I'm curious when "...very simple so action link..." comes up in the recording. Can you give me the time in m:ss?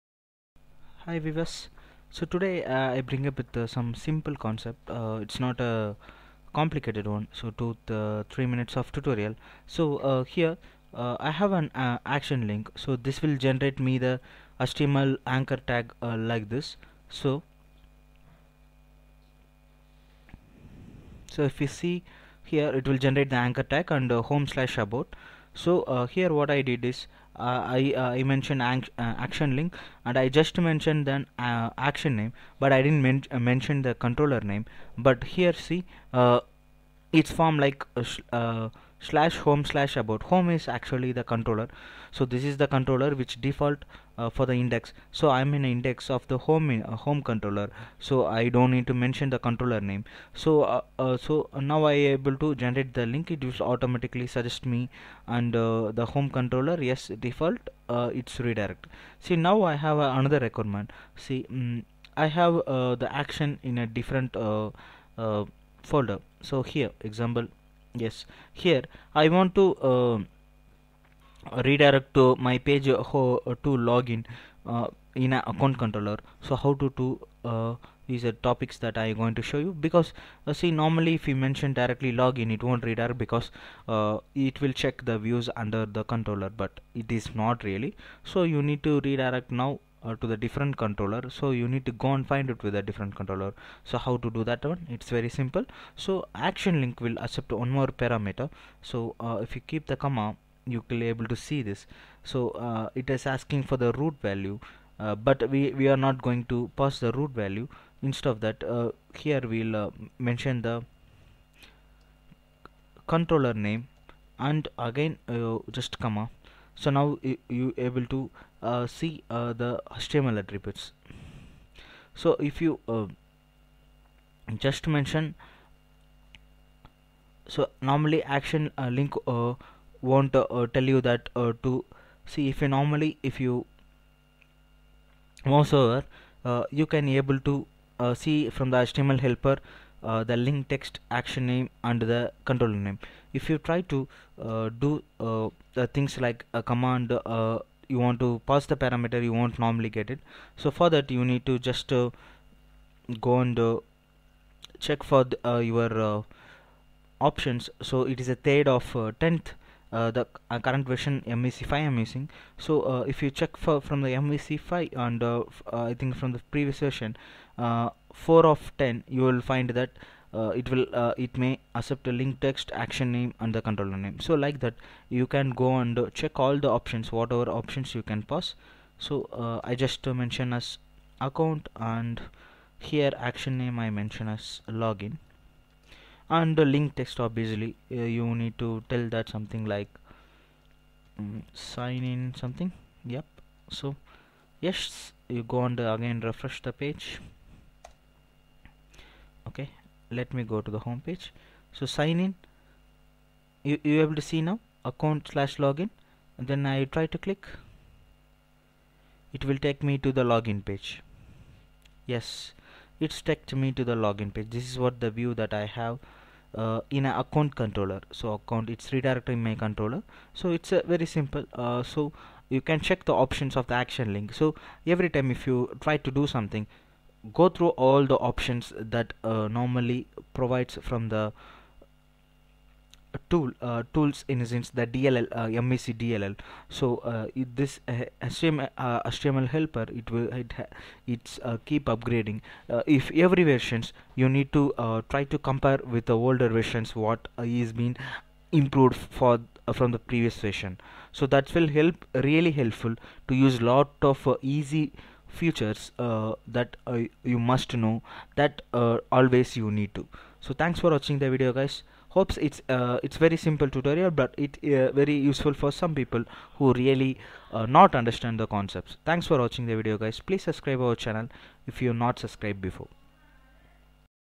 1:35.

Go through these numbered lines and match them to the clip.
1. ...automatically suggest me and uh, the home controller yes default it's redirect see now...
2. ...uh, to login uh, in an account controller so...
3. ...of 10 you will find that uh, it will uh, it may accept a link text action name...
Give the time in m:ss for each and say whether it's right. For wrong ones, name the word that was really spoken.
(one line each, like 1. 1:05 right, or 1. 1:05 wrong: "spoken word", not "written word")
1. 0:53 right
2. 1:12 right
3. 2:48 right.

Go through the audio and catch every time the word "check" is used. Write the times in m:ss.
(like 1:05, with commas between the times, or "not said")
1:24, 2:34, 2:43, 2:56, 3:42.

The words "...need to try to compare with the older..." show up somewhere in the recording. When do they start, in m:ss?
4:04.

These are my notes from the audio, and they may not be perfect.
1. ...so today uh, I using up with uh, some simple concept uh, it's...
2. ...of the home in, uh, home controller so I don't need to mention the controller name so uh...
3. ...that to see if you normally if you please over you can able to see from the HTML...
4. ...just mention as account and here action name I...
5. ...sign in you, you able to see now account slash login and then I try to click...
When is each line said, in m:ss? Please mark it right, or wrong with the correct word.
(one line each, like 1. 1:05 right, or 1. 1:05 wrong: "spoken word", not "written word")
1. 0:02 wrong: "bring", not "using"
2. 0:46 right
3. 2:11 wrong: "mouse", not "please"
4. 2:59 right
5. 3:21 right.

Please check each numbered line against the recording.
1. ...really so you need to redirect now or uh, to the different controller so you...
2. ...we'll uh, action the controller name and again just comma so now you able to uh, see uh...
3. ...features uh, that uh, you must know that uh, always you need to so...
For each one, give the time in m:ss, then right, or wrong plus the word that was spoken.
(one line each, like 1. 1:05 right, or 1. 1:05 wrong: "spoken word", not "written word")
1. 1:27 right
2. 1:49 wrong: "mention", not "action"
3. 4:15 right.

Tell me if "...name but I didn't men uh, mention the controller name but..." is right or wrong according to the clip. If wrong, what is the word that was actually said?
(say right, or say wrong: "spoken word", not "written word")
right.